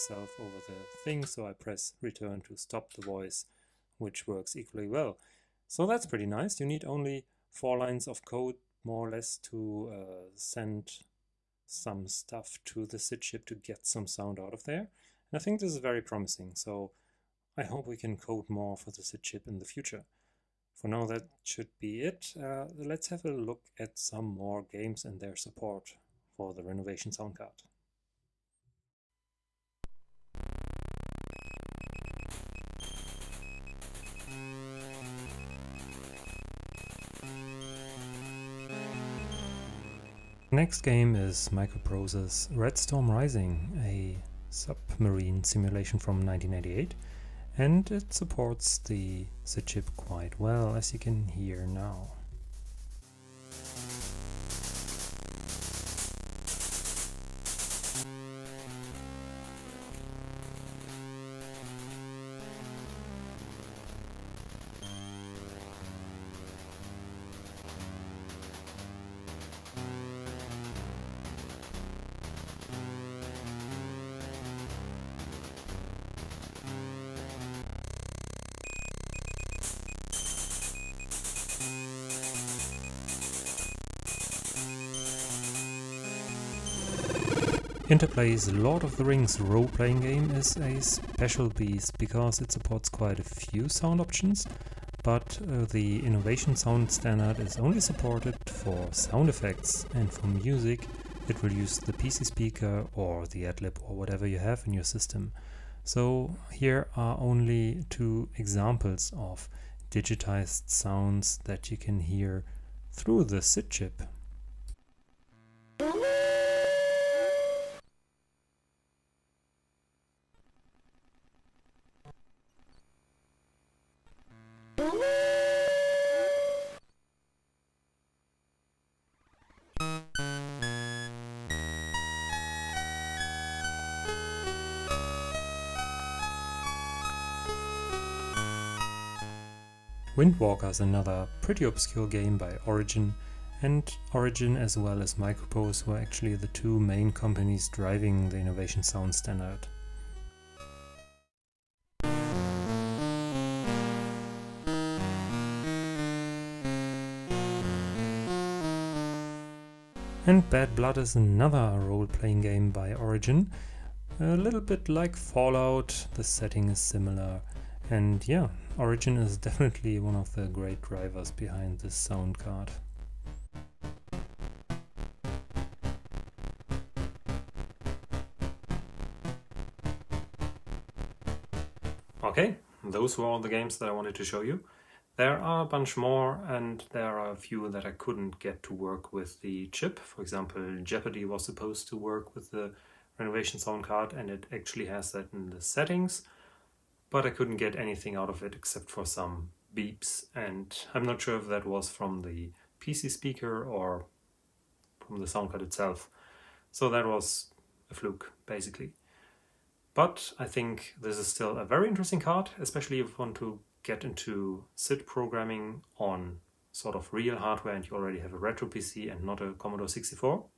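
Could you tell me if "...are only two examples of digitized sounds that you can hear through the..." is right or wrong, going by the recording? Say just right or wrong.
right.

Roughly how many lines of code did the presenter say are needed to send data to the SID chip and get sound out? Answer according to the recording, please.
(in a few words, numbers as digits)
4.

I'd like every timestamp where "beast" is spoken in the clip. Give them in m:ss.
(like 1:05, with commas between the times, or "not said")
1:31.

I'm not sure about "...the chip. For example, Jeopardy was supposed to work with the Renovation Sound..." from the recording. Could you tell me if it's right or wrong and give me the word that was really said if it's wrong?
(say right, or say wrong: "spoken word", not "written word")
right.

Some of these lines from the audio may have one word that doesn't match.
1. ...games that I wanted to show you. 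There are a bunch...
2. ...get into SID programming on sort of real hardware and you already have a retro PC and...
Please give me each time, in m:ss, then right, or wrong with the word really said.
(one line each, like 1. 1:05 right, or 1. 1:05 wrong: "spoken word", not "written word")
1. 3:03 right
2. 3:33 right.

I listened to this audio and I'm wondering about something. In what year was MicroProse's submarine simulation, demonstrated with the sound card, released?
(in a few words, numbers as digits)
1988.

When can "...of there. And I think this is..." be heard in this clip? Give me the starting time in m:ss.
0:14.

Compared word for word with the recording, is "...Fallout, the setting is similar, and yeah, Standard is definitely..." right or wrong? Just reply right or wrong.
wrong.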